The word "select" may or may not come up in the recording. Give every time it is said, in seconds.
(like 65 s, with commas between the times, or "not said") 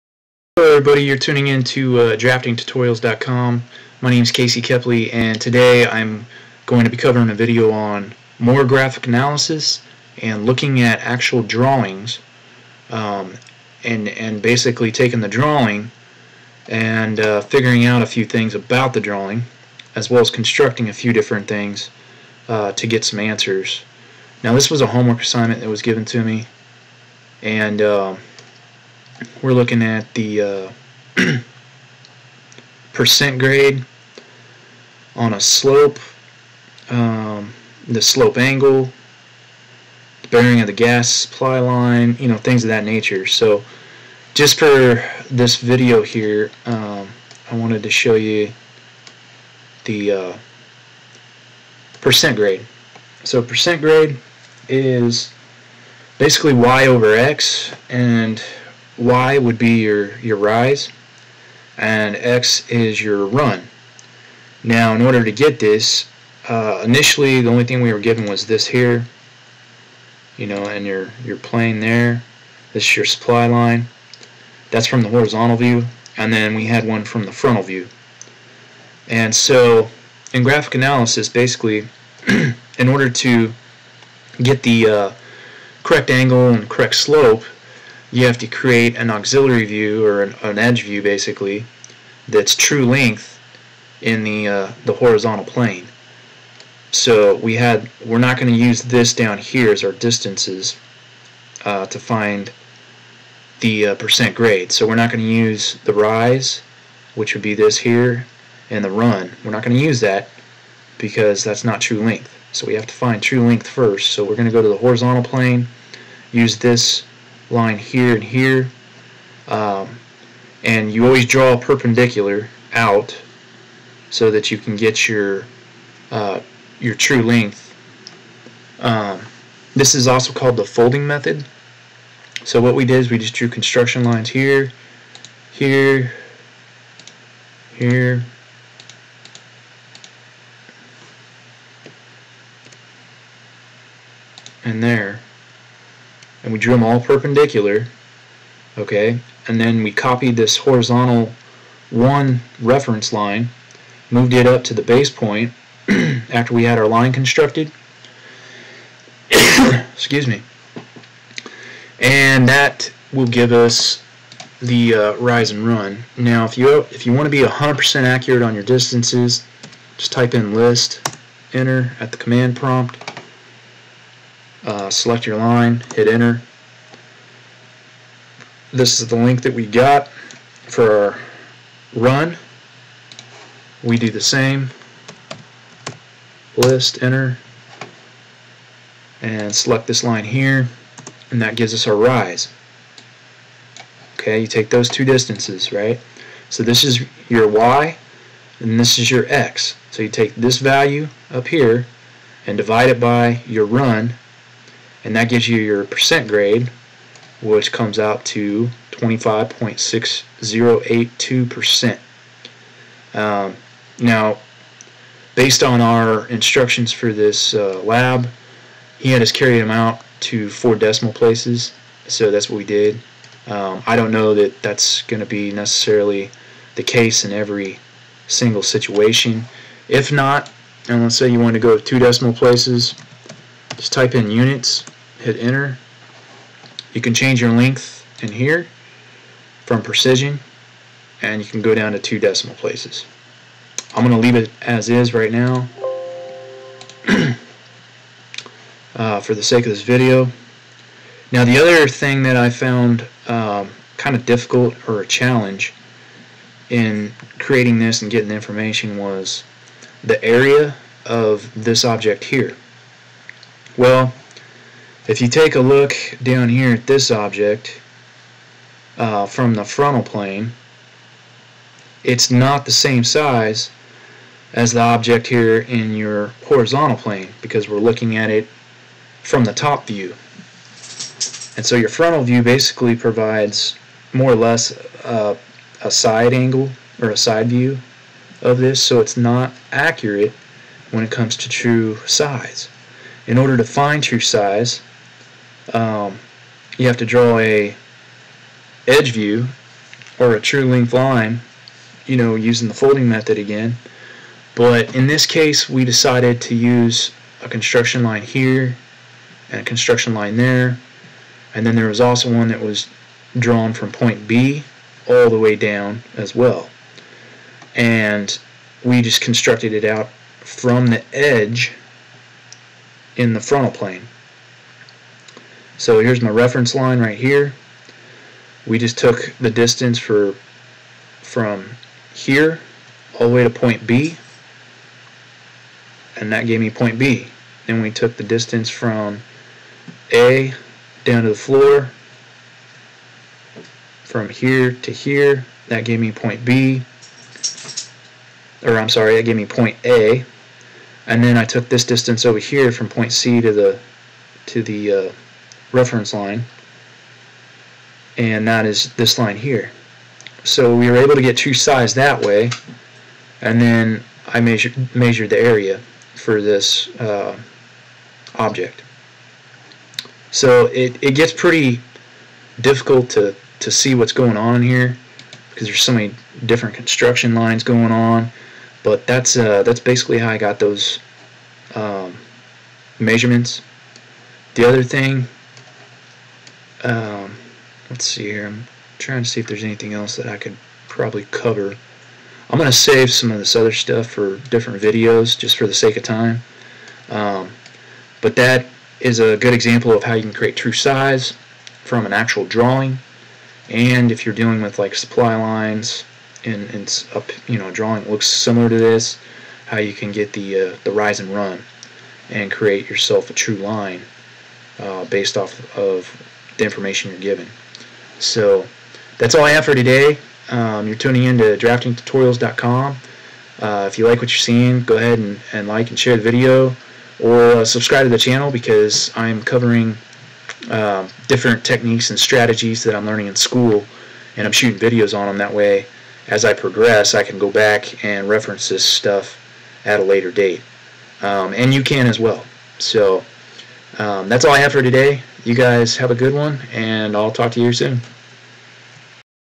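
174 s, 189 s.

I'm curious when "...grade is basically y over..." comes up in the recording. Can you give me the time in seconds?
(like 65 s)
53 s.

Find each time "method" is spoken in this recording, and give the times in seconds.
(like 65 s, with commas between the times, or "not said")
131 s, 303 s.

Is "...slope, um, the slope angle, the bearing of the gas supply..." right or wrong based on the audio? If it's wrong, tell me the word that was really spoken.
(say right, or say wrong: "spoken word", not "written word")
right.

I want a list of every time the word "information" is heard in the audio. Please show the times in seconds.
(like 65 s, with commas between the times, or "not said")
258 s, 416 s.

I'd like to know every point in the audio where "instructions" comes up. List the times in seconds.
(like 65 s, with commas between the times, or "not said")
216 s.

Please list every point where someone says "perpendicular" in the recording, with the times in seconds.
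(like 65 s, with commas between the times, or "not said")
121 s, 146 s.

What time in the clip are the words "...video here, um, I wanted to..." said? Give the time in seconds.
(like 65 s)
45 s.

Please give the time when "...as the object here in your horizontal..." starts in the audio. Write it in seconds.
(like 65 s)
274 s.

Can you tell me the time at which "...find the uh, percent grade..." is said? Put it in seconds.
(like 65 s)
101 s.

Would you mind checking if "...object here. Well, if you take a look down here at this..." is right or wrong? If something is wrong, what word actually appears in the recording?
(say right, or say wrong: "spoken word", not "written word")
right.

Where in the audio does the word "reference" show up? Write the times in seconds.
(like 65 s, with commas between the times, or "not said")
152 s, 326 s, 355 s, 438 s.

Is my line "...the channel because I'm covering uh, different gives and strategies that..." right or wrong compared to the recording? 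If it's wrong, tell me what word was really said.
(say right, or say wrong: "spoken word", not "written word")
wrong: "techniques", not "gives".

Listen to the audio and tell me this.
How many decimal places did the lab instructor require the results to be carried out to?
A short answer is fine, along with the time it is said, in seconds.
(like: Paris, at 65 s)
4, at 220 s.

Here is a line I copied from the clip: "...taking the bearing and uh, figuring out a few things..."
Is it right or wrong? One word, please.
wrong.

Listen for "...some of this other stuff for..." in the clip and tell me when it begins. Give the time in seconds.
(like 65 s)
393 s.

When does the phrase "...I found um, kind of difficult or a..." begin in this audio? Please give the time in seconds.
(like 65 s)
252 s.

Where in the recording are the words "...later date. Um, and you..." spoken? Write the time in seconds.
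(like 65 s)
440 s.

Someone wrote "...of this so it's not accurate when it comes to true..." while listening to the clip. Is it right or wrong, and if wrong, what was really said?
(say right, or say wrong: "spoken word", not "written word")
right.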